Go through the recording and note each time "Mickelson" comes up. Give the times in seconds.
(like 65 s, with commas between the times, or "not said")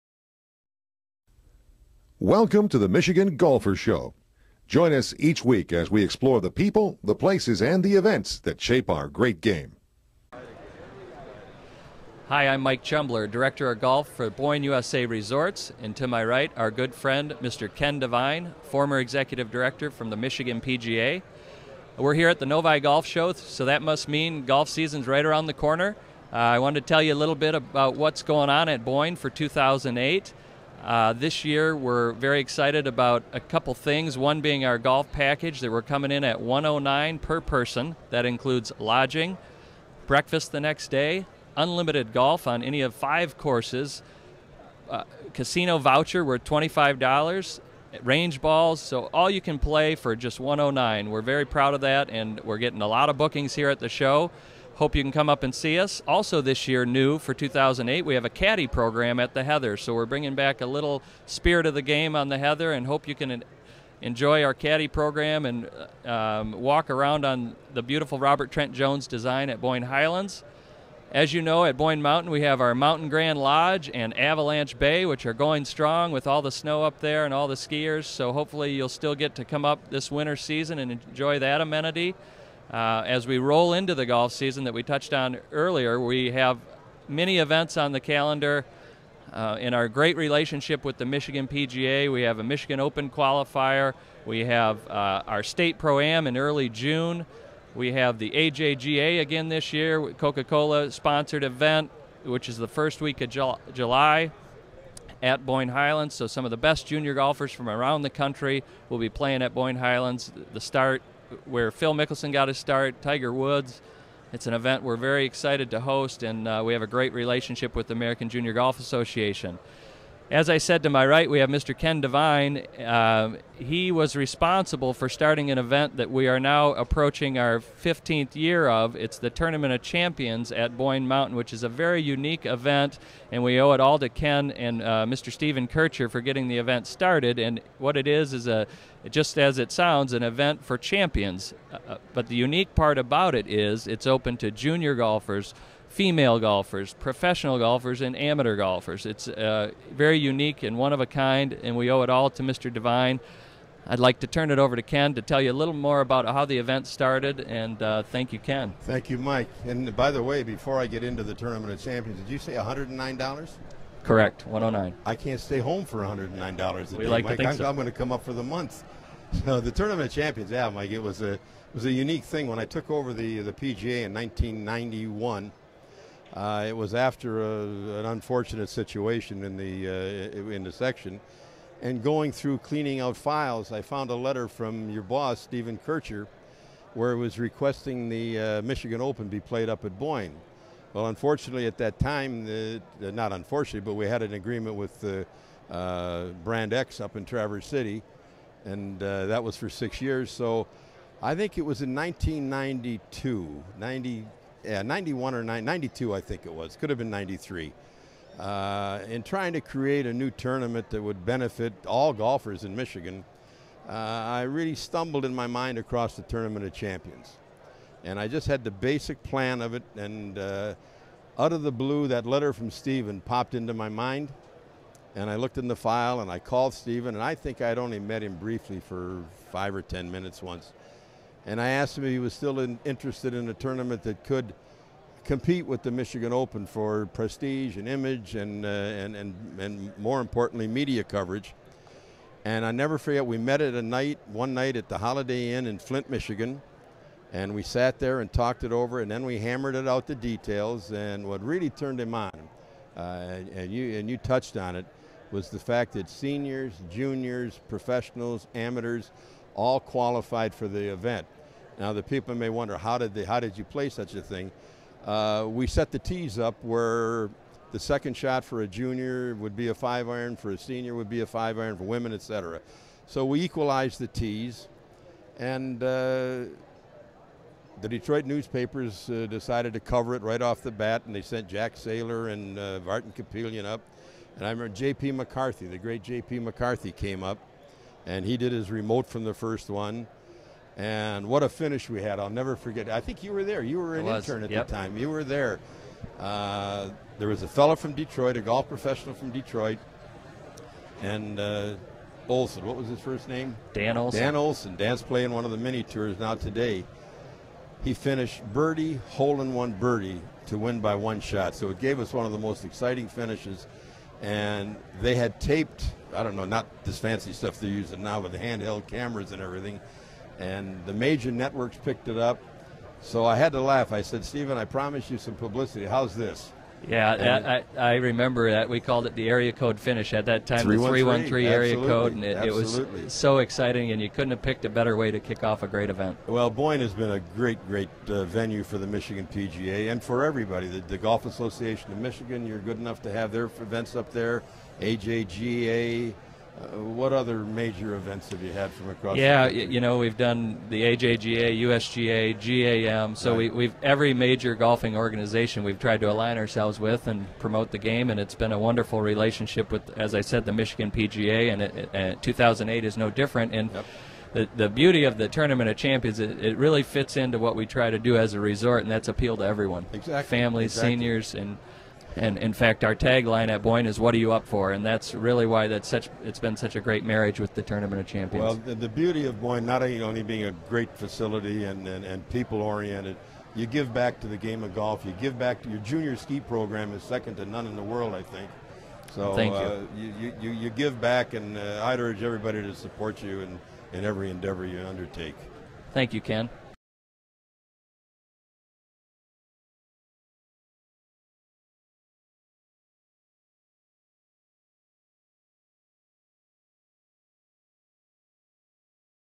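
111 s.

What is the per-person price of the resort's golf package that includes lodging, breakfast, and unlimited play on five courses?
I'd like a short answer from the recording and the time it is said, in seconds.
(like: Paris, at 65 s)
$109, at 36 s.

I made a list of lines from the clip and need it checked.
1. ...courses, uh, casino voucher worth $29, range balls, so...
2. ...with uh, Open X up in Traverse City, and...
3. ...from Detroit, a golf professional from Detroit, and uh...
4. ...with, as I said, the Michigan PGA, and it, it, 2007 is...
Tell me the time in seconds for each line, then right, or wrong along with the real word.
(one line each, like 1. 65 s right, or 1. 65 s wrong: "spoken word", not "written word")
1. 43 s wrong: "25", not "29"
2. 194 s wrong: "Brand", not "Open"
3. 297 s right
4. 359 s wrong: "2008", not "2007".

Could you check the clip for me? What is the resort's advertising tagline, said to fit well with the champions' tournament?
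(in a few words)
What are you up for?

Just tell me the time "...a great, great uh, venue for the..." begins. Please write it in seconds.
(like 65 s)
337 s.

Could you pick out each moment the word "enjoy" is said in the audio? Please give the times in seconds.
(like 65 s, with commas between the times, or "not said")
64 s, 80 s.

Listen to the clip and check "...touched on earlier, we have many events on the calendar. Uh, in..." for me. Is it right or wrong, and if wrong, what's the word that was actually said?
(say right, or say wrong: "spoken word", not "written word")
right.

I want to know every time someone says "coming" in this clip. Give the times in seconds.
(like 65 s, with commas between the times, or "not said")
35 s.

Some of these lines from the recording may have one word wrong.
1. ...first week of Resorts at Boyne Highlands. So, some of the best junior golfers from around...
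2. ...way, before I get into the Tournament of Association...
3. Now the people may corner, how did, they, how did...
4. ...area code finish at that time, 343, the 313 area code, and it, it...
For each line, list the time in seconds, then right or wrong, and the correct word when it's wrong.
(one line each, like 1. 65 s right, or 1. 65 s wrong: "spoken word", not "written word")
1. 102 s wrong: "July", not "Resorts"
2. 160 s wrong: "Champions", not "Association"
3. 261 s wrong: "wonder", not "corner"
4. 329 s wrong: "313", not "343".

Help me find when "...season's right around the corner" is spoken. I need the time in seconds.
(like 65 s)
24 s.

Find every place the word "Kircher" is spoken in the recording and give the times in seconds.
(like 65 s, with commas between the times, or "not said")
135 s, 185 s.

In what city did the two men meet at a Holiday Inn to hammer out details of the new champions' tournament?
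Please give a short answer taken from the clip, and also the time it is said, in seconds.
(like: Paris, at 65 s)
Flint, Michigan, at 245 s.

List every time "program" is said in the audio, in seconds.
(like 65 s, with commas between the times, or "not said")
58 s, 64 s, 386 s.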